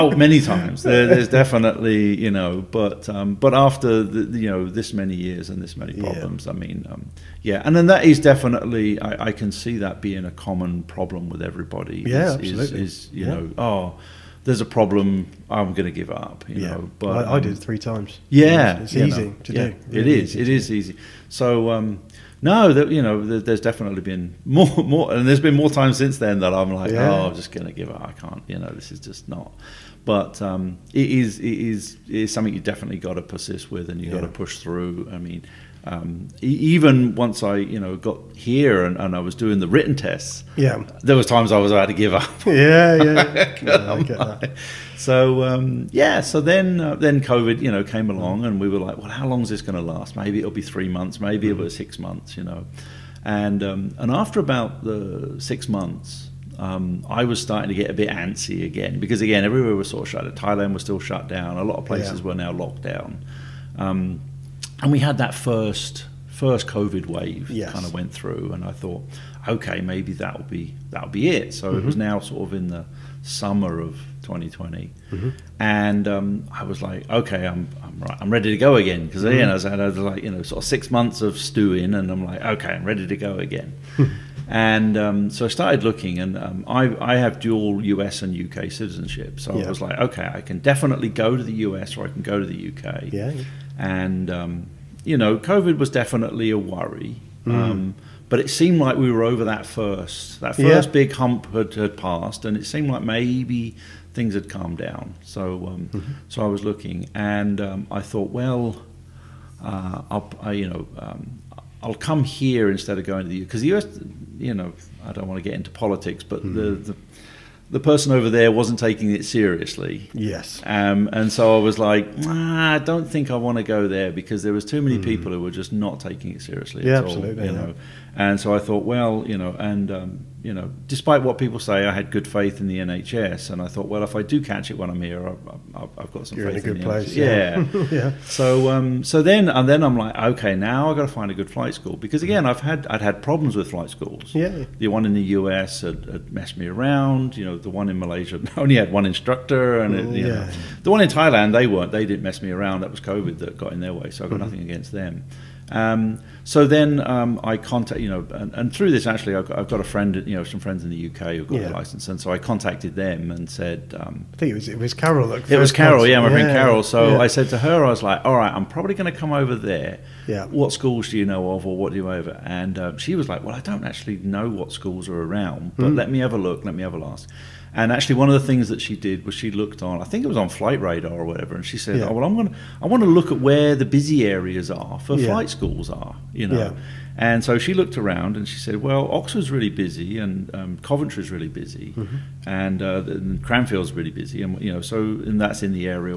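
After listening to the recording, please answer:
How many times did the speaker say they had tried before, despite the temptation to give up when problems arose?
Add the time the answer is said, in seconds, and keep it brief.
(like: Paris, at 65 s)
3, at 17 s.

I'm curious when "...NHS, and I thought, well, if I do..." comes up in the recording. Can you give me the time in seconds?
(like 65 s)
132 s.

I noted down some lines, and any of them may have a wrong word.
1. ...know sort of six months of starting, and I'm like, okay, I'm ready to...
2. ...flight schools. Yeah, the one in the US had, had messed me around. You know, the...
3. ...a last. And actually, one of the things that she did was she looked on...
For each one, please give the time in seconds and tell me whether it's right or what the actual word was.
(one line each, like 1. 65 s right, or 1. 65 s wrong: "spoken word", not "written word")
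1. 80 s wrong: "stewing", not "starting"
2. 143 s right
3. 176 s right.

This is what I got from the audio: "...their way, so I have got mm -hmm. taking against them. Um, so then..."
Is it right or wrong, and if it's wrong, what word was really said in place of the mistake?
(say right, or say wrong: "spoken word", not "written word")
wrong: "nothing", not "taking".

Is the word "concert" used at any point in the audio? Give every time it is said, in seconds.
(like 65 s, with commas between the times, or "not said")
165 s.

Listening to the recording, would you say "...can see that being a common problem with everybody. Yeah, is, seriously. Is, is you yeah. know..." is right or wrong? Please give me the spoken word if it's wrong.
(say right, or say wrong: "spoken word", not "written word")
wrong: "absolutely", not "seriously".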